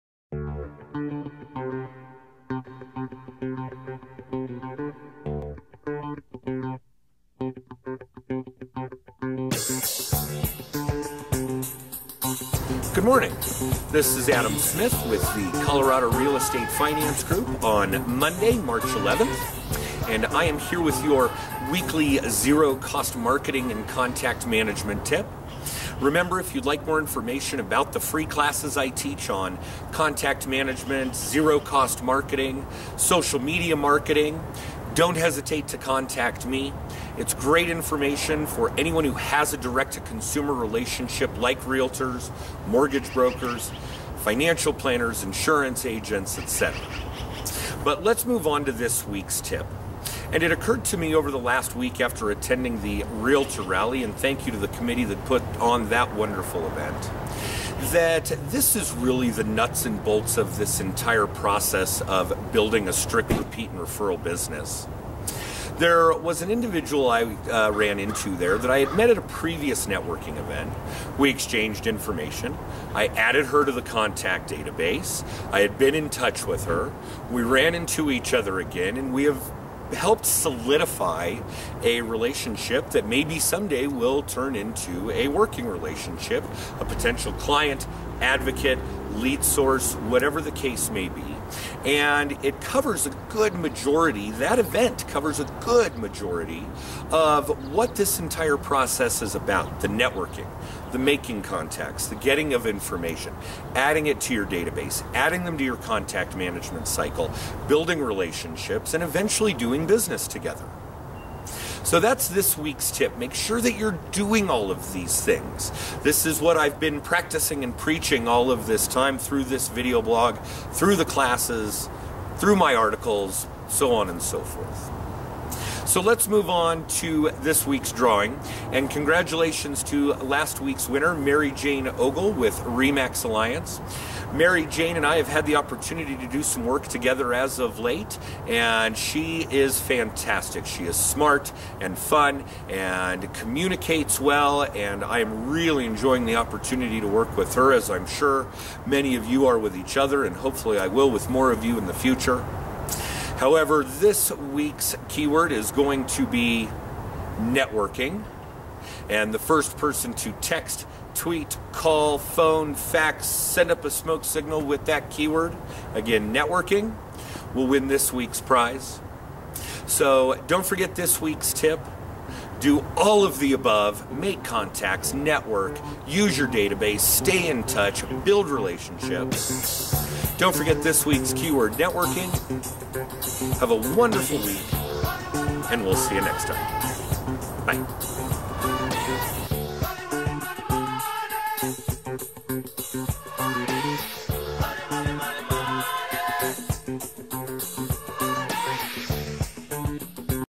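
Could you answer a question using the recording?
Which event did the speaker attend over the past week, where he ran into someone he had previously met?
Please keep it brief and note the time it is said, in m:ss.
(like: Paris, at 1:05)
Realtor Rally, at 0:53.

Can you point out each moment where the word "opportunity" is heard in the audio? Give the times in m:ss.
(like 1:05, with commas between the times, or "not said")
2:15, 2:26.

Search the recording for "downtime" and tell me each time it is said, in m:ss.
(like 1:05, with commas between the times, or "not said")
not said.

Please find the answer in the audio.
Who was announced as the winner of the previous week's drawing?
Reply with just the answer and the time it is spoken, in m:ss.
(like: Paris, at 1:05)
Mary Jane Ogle, at 2:11.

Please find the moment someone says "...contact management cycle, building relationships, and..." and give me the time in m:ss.
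1:45.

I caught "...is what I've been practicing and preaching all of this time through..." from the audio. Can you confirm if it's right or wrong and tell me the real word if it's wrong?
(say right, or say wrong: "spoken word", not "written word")
right.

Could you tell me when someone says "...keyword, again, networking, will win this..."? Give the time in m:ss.
2:45.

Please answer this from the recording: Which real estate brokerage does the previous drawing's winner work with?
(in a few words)
Remax Alliance.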